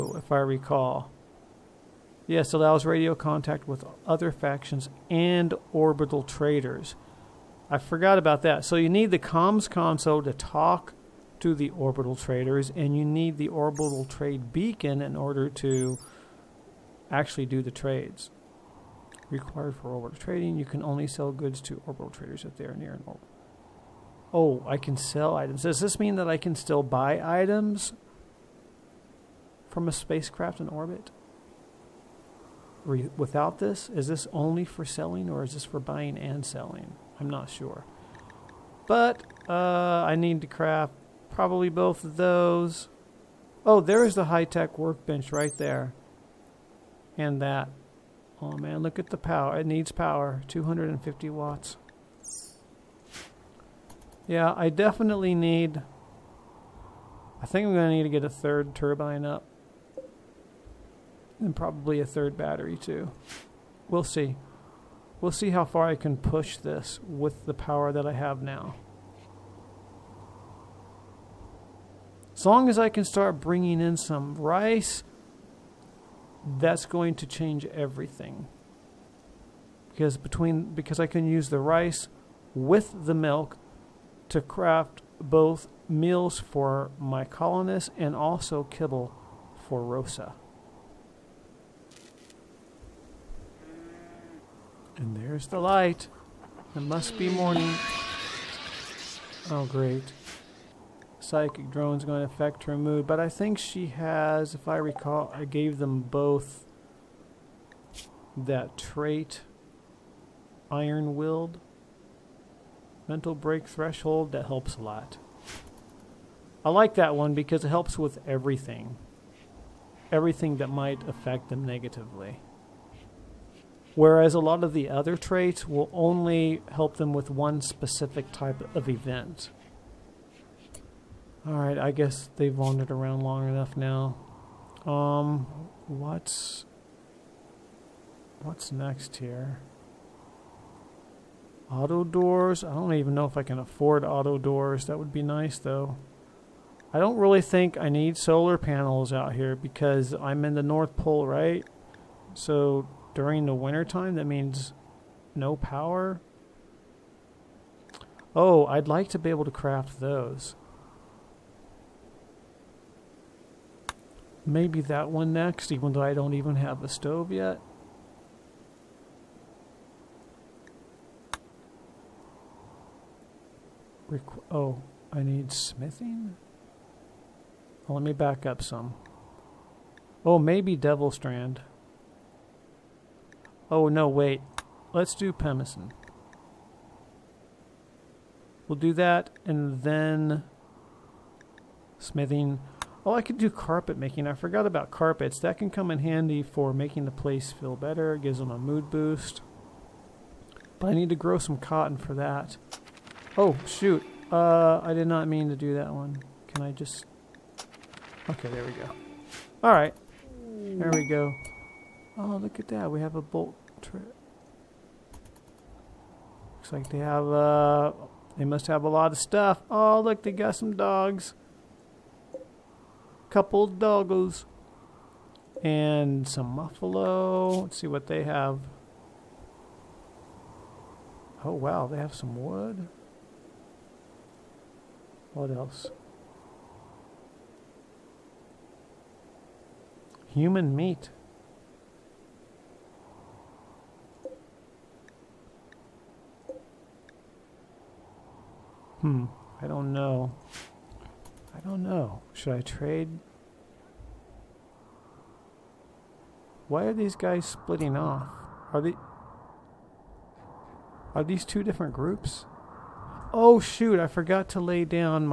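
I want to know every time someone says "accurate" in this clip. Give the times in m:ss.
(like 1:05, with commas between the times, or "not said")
not said.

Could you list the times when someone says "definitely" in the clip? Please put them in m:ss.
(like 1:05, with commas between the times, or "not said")
0:54.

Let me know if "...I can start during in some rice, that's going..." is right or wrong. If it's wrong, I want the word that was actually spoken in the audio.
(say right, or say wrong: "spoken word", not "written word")
wrong: "bringing", not "during".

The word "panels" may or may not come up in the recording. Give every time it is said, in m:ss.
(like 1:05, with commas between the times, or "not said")
2:28.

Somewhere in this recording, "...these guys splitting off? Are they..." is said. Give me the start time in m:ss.
4:16.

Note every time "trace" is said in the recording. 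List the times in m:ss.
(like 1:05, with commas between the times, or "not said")
not said.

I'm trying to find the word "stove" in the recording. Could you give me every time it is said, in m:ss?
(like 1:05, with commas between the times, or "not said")
2:46.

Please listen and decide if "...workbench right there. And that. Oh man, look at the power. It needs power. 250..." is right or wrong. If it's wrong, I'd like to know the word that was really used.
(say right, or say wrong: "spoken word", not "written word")
right.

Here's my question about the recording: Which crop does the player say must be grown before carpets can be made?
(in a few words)
Cotton.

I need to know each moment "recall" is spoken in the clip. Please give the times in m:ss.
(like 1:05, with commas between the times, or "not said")
0:00, 1:44.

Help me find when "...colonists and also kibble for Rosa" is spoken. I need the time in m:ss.
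1:27.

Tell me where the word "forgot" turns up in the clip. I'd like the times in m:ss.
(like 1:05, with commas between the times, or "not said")
0:07, 3:14, 4:24.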